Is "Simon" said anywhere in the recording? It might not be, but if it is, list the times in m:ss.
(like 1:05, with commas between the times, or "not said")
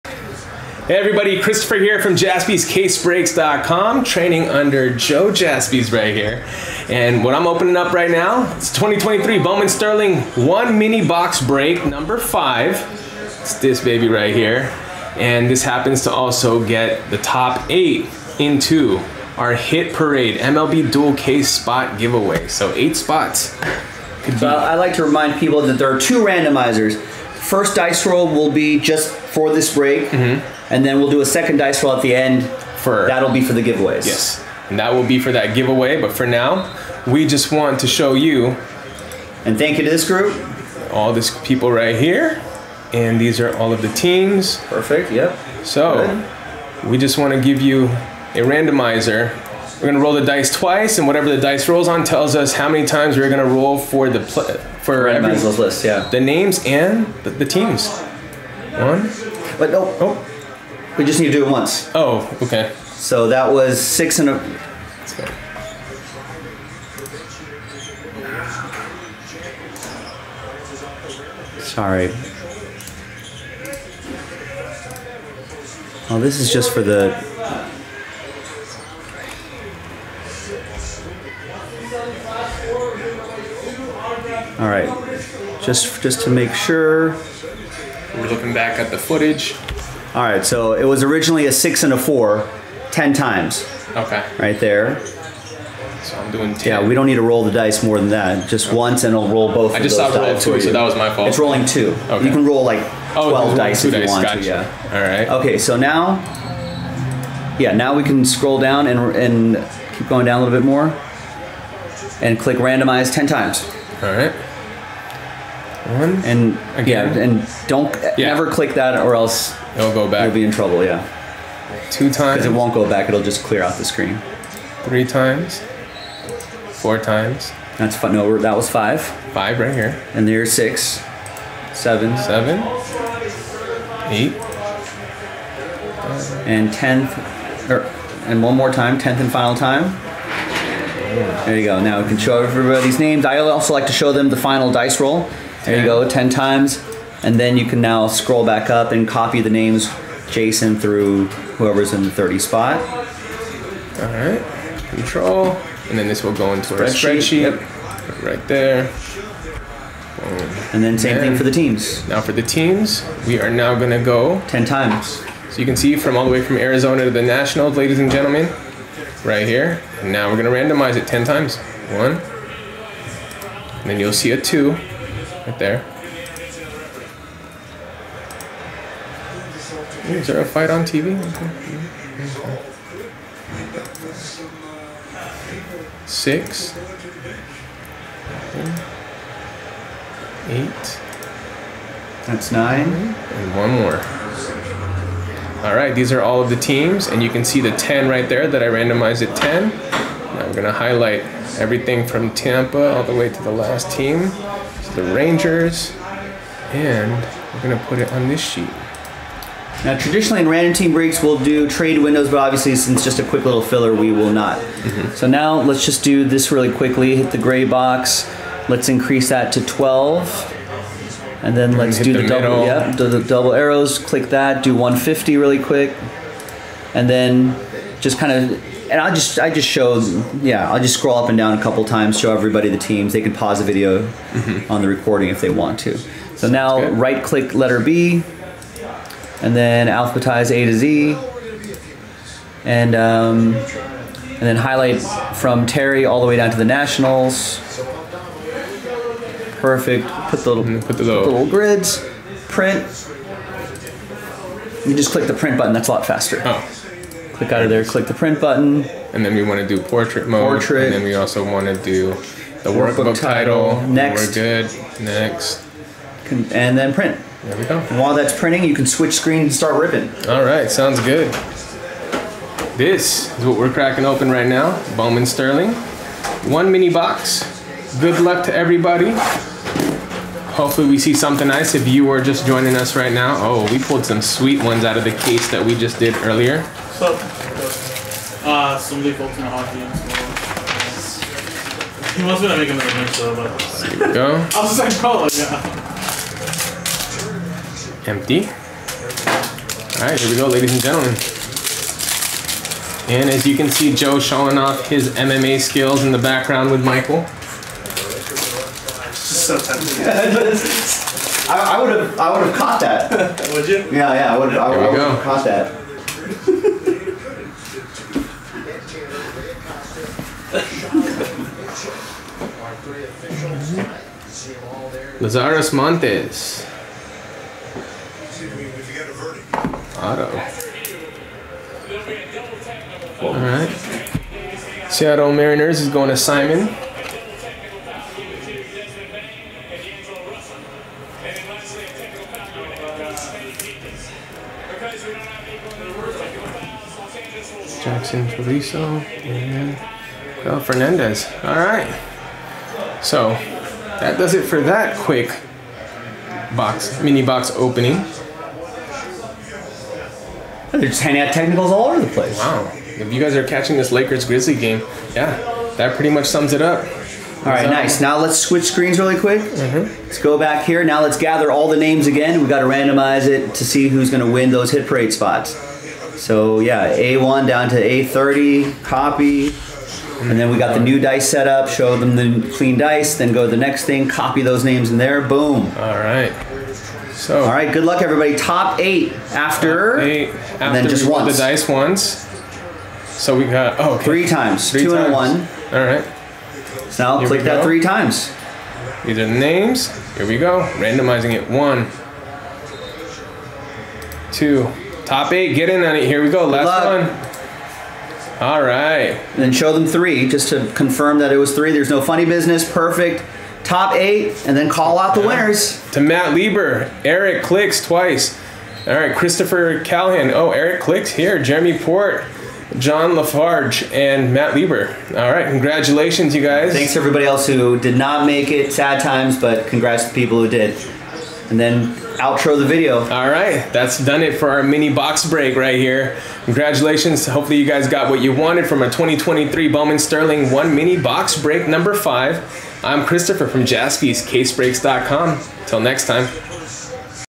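5:36.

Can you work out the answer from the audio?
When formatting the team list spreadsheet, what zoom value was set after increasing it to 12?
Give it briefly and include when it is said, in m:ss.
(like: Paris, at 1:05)
150, at 3:44.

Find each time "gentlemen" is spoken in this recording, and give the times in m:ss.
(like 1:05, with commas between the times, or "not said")
2:48, 5:00.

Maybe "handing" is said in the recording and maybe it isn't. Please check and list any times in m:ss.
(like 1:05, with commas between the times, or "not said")
6:01.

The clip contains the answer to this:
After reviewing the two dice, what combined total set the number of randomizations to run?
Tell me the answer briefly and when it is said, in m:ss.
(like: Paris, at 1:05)
10, at 1:32.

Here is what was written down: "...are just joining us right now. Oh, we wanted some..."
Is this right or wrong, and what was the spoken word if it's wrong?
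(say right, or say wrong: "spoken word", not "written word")
wrong: "pulled", not "wanted".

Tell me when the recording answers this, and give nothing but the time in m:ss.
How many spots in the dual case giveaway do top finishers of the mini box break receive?
0:22.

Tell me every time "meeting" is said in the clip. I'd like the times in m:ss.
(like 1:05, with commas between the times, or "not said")
not said.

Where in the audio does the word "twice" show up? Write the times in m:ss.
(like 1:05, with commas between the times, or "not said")
0:50, 6:57.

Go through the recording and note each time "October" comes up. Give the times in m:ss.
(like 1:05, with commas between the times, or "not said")
not said.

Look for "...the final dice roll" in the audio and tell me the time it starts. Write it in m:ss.
2:24.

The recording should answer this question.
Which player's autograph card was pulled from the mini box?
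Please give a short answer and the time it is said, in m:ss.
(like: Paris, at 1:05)
Lazaro Montes, at 5:25.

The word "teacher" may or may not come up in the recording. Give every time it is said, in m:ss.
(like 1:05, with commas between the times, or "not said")
not said.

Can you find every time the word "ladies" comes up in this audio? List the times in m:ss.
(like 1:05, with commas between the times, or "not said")
2:47, 5:00.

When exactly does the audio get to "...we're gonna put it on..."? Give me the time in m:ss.
3:27.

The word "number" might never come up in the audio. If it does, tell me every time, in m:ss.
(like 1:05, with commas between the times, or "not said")
0:11, 7:21.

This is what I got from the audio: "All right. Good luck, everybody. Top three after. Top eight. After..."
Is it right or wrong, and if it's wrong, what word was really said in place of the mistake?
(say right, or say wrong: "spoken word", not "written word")
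wrong: "eight", not "three".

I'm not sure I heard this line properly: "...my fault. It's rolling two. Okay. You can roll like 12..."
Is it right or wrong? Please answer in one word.
right.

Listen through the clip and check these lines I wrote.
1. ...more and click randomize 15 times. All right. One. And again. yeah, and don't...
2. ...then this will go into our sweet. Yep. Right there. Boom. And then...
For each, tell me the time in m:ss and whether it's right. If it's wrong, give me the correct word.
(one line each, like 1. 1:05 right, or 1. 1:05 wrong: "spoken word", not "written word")
1. 1:50 wrong: "10", not "15"
2. 2:35 wrong: "spreadsheet", not "sweet".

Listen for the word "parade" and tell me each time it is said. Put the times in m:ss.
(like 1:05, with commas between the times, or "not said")
0:19, 6:14.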